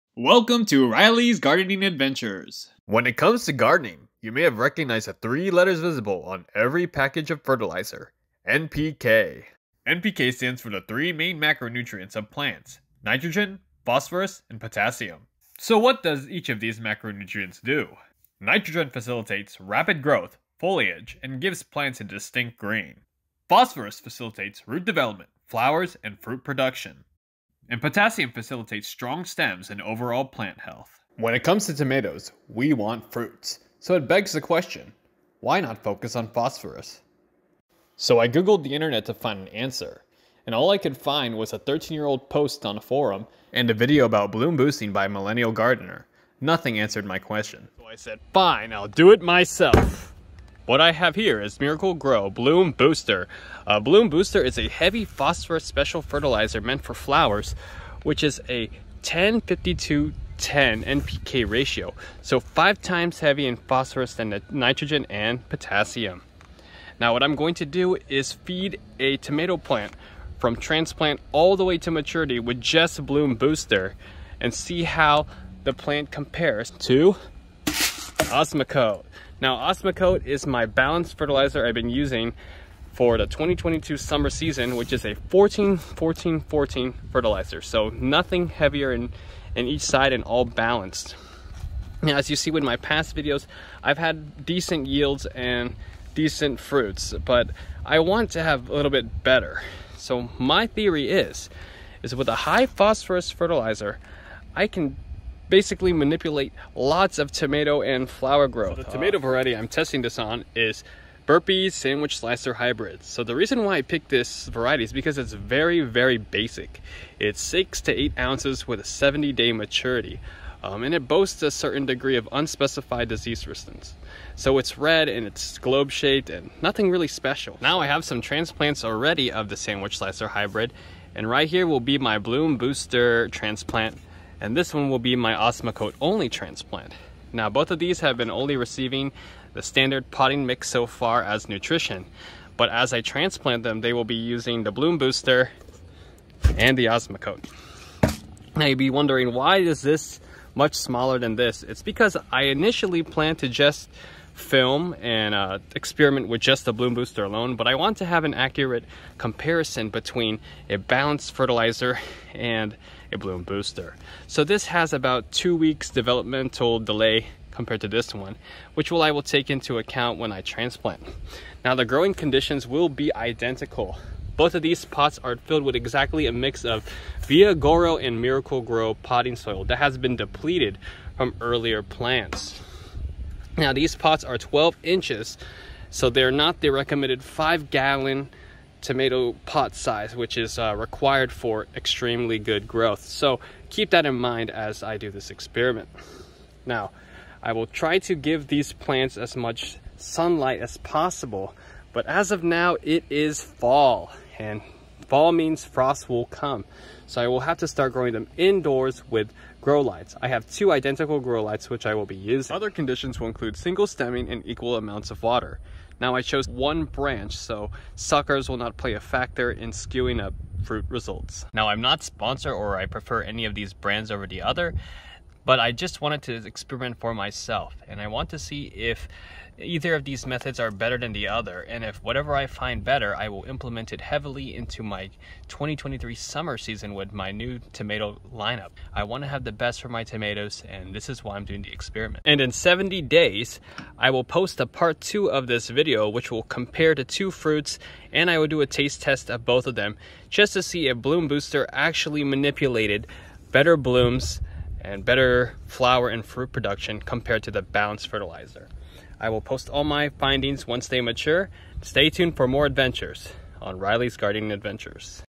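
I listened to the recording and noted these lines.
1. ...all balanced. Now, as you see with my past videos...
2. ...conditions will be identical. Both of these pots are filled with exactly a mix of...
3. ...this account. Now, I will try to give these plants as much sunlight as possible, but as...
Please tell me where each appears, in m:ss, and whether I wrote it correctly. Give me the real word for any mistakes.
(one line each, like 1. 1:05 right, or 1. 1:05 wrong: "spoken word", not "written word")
1. 1:30 right
2. 2:52 right
3. 3:15 wrong: "experiment", not "account".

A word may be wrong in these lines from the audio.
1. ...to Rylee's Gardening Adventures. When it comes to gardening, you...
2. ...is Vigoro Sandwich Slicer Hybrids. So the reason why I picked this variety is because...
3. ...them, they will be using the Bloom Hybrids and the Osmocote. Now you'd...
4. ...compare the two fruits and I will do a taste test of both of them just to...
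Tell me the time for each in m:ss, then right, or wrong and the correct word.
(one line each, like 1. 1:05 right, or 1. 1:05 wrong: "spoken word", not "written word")
1. 0:00 right
2. 1:50 wrong: "Burpees", not "Vigoro"
3. 2:23 wrong: "Booster", not "Hybrids"
4. 4:06 right.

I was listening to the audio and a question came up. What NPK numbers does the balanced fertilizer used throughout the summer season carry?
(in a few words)
14-14-14.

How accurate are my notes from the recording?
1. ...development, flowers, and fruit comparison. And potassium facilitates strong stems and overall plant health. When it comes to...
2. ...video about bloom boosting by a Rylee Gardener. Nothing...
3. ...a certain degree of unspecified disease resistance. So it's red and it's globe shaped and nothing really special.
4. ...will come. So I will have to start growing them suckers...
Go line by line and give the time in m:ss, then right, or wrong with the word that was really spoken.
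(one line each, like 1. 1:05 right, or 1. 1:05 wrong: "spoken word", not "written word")
1. 0:24 wrong: "production", not "comparison"
2. 0:43 wrong: "Millennial", not "Rylee"
3. 2:01 right
4. 3:26 wrong: "indoors", not "suckers".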